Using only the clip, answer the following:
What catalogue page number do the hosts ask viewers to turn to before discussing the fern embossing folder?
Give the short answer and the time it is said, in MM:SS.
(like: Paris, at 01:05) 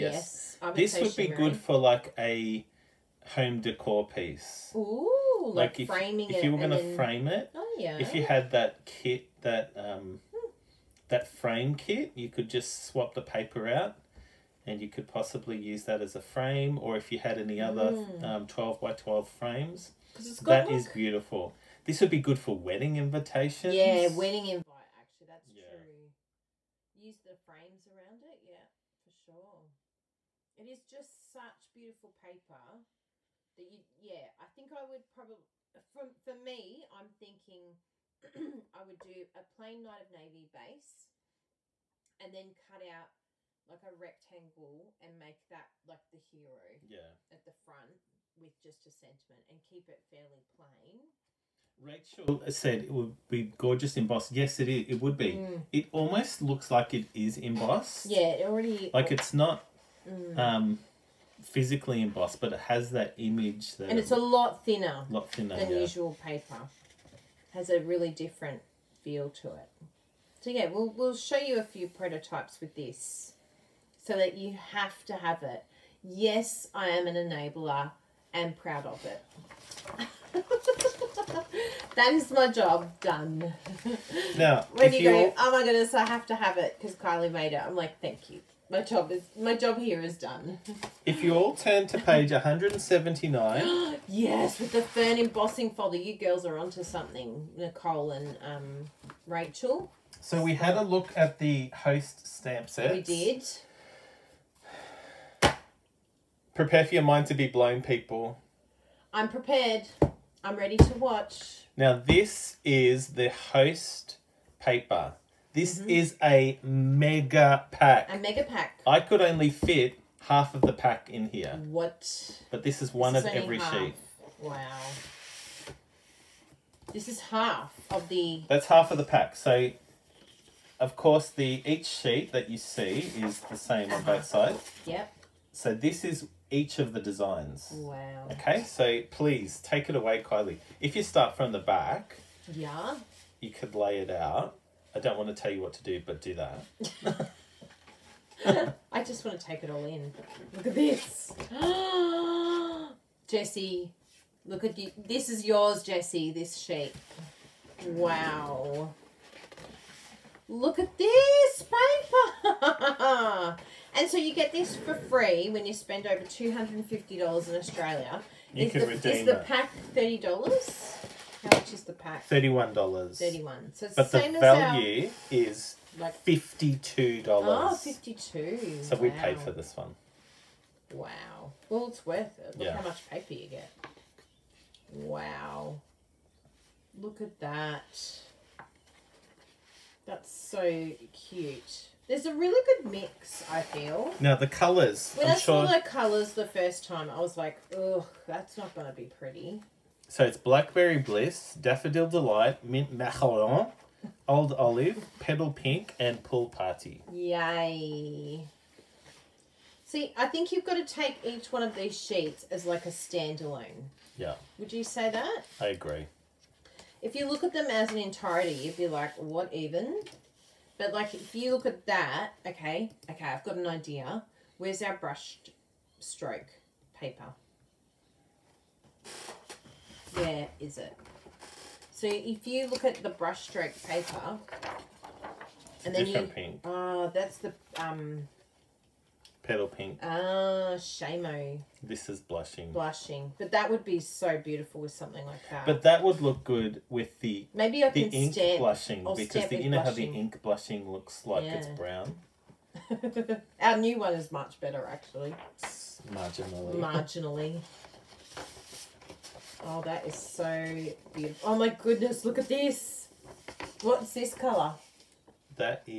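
179, at 01:31.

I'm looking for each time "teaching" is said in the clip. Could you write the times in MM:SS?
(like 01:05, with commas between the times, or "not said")
not said.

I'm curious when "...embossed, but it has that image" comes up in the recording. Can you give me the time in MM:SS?
01:02.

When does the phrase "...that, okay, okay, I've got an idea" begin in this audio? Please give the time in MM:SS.
03:41.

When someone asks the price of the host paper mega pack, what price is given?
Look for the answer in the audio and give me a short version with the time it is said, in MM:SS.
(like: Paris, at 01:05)
$31, at 02:52.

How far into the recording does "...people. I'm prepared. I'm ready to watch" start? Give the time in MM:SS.
01:47.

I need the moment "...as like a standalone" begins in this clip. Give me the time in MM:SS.
03:32.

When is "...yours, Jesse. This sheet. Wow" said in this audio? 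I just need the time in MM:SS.
02:35.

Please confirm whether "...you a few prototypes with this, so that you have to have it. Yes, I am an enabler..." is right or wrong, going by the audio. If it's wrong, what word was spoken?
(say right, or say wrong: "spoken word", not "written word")
right.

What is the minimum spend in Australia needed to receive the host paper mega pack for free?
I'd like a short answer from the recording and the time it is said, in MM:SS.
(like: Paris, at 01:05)
$250, at 02:46.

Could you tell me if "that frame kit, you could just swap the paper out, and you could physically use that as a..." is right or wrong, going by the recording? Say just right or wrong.
wrong.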